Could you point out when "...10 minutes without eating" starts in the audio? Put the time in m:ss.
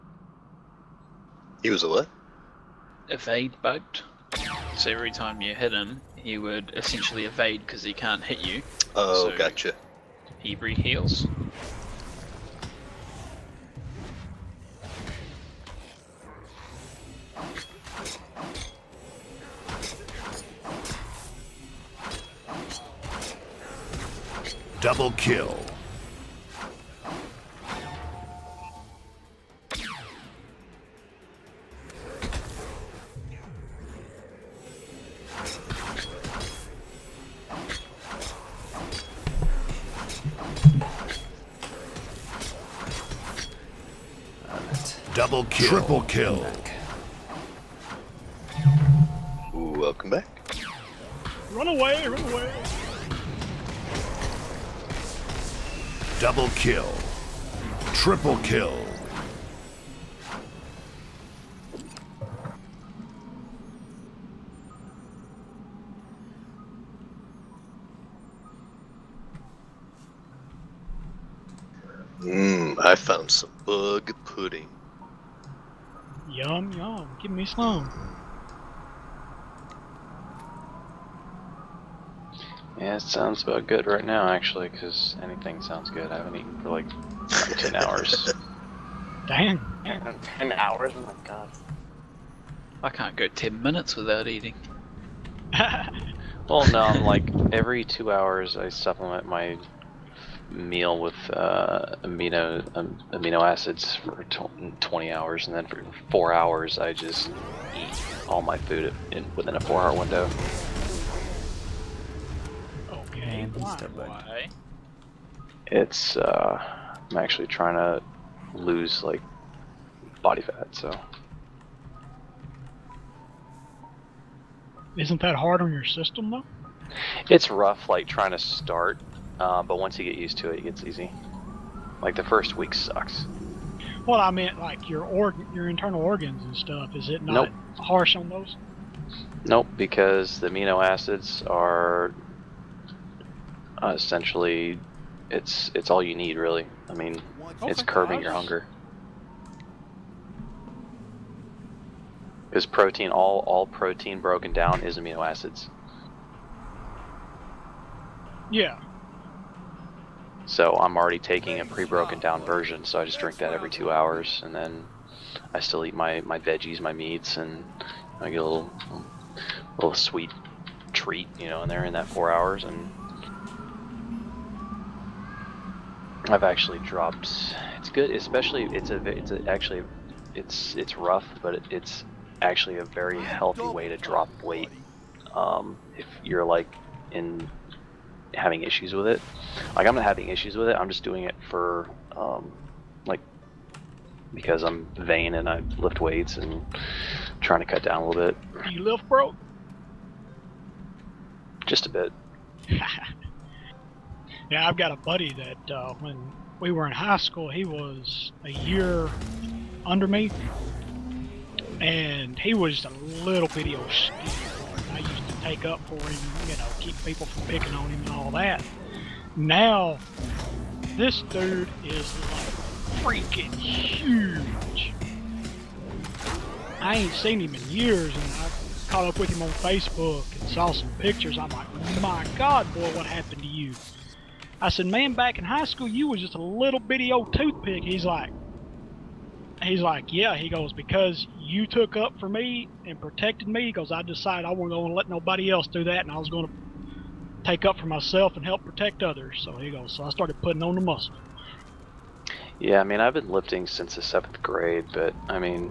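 1:33.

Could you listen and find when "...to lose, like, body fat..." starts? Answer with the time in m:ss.
1:57.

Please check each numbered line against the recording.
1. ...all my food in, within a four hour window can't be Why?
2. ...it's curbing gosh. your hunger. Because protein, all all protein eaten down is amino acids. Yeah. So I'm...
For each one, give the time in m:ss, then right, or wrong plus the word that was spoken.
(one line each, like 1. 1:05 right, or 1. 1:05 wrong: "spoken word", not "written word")
1. 1:48 right
2. 2:27 wrong: "broken", not "eaten".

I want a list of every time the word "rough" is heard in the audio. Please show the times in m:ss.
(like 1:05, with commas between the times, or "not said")
2:07, 3:00.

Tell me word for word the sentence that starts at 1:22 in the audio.
Yeah, it sounds about good right now, actually, because anything sounds good.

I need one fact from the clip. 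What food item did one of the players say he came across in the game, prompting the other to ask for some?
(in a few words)
bug pudding.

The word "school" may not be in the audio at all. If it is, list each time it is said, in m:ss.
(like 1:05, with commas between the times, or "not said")
3:27, 3:55.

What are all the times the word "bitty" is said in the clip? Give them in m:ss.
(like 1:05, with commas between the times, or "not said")
3:33, 3:56.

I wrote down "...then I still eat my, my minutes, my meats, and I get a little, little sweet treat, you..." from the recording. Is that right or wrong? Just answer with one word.
wrong.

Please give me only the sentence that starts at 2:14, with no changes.
Well, I meant, like, your organ, your internal organs and stuff.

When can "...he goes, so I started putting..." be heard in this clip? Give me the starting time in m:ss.
4:09.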